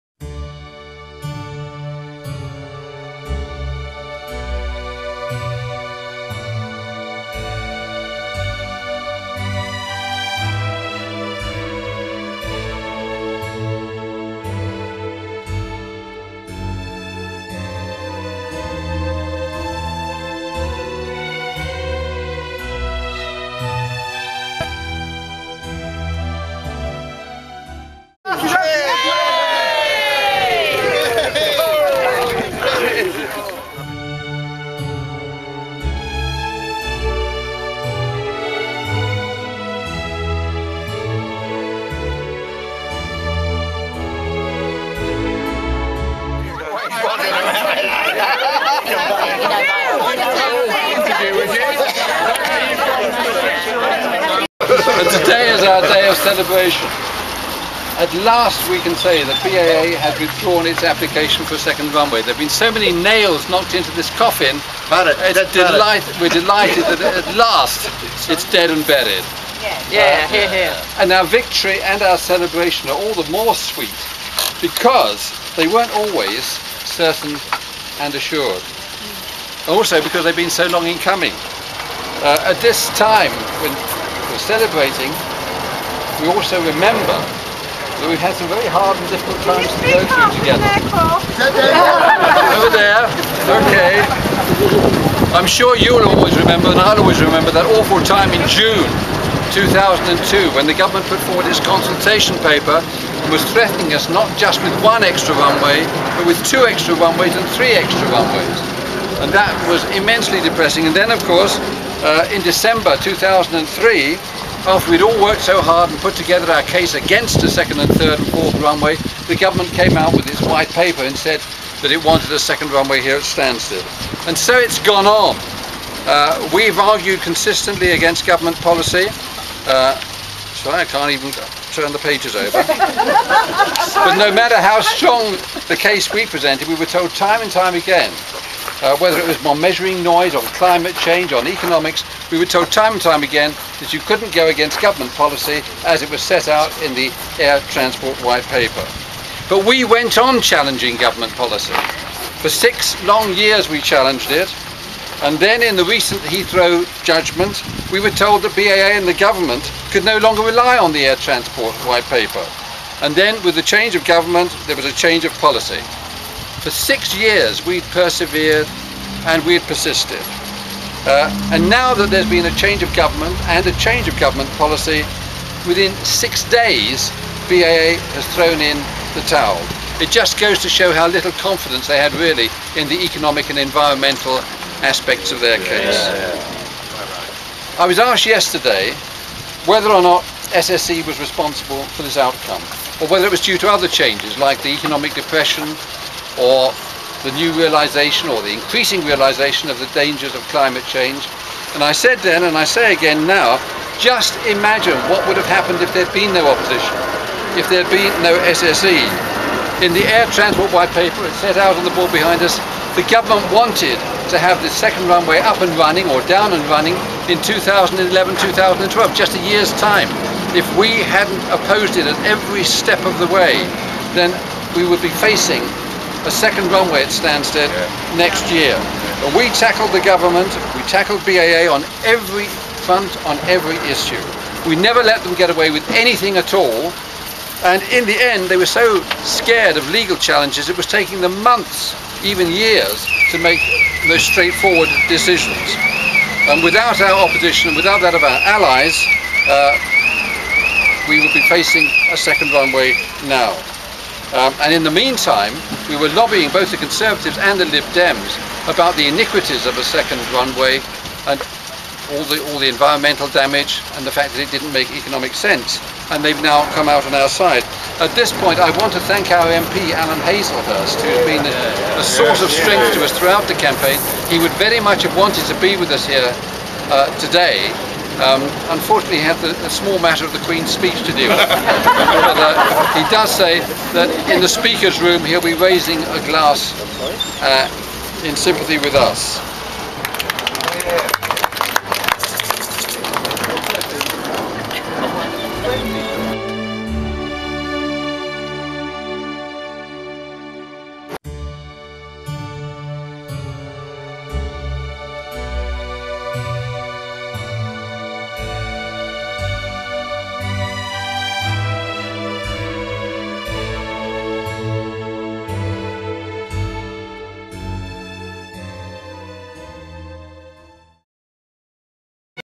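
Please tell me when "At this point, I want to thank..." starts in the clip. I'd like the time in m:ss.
4:27.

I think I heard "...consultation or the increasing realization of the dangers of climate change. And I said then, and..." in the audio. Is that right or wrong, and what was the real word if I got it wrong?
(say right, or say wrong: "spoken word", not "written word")
wrong: "realization", not "consultation".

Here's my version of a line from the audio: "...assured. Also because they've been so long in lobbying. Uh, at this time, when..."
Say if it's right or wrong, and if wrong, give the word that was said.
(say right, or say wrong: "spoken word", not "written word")
wrong: "coming", not "lobbying".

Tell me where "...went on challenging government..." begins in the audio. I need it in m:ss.
2:29.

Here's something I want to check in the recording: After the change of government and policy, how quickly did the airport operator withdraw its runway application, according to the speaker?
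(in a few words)
6 days.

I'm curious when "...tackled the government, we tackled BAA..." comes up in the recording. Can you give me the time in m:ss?
3:49.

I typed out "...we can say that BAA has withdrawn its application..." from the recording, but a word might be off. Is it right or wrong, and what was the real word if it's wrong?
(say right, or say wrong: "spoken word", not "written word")
right.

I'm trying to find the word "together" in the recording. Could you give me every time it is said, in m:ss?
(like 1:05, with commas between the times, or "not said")
1:30, 1:56.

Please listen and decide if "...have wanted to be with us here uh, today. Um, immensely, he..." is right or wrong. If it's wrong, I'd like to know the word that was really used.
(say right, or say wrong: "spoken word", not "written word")
wrong: "unfortunately", not "immensely".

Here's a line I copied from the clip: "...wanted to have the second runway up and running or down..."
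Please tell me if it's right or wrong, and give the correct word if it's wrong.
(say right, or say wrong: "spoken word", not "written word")
right.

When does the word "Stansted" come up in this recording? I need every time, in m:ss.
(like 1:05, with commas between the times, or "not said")
2:03, 3:47.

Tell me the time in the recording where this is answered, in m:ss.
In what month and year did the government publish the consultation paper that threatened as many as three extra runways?
1:38.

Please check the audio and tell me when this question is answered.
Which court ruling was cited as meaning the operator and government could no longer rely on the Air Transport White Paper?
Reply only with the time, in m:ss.
2:36.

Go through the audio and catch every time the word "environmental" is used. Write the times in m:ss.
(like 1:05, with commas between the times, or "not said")
3:03, 4:22.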